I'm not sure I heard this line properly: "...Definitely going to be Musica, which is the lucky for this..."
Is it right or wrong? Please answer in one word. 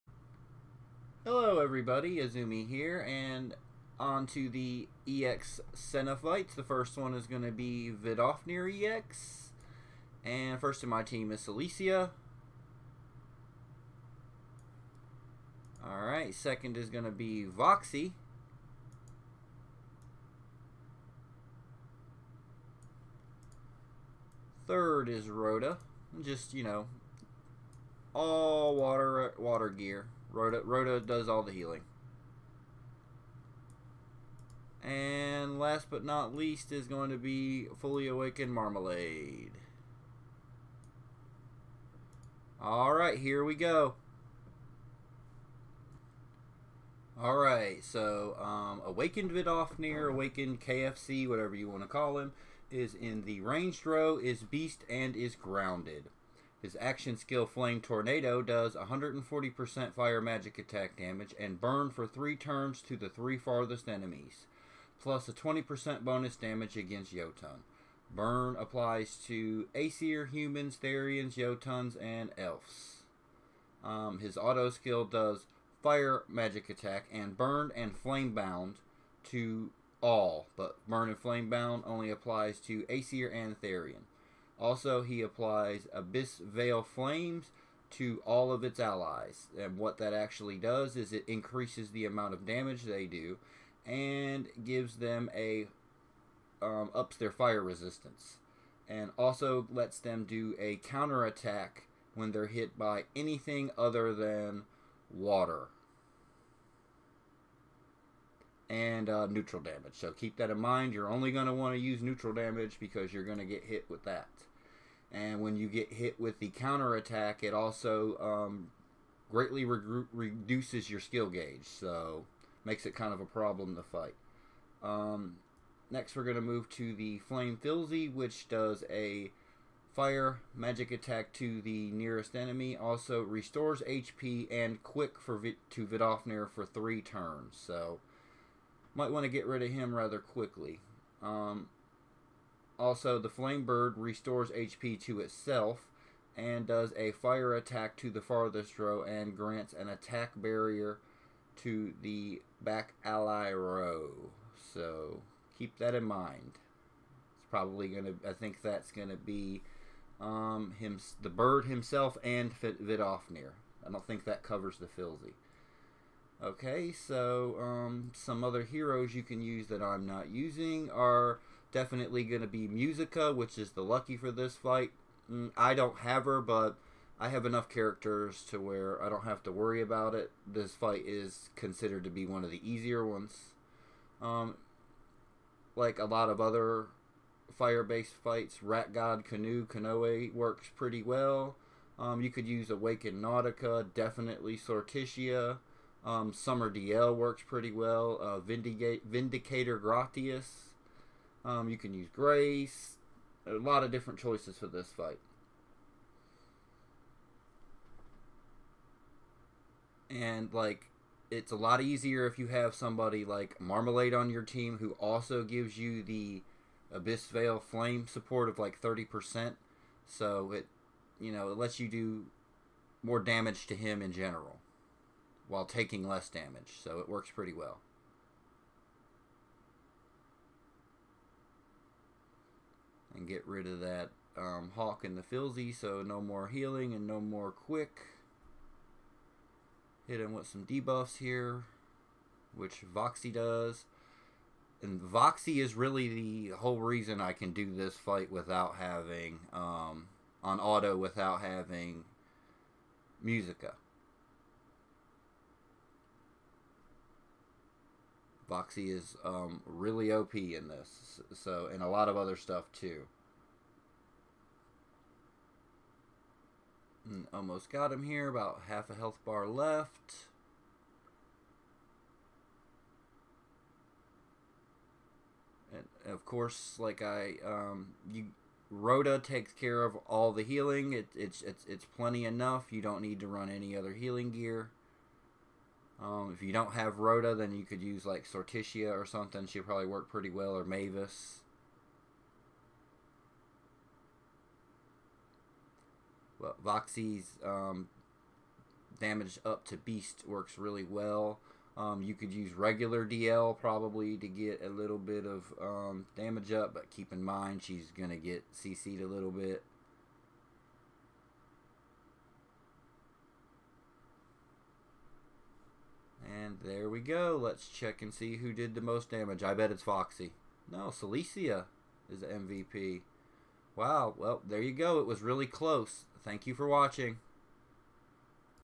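right.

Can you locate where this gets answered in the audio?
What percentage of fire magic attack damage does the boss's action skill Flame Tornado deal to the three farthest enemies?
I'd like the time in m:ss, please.
0:58.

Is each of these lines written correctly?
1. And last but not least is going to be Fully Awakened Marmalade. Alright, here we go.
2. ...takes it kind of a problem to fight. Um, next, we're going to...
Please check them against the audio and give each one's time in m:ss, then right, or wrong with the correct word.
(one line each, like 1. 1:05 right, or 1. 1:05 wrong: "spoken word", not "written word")
1. 0:34 right
2. 2:02 wrong: "makes", not "takes".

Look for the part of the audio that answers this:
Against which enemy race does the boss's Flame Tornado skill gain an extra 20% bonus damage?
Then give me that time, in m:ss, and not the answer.
1:07.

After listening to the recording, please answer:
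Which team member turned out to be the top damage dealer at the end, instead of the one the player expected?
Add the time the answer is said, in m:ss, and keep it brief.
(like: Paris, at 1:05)
Silesia, at 5:20.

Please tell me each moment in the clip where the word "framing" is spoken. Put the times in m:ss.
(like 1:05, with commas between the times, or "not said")
not said.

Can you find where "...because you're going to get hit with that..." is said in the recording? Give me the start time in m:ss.
1:52.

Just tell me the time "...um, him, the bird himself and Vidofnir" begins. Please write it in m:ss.
2:40.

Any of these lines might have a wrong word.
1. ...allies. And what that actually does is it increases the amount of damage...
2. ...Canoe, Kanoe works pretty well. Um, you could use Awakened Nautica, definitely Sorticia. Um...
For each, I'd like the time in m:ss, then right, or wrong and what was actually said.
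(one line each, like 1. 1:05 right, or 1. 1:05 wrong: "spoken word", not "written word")
1. 1:28 right
2. 3:09 right.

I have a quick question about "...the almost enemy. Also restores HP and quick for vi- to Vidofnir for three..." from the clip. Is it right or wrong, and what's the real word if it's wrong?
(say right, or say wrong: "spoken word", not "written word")
wrong: "nearest", not "almost".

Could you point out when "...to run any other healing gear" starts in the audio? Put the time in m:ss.
4:43.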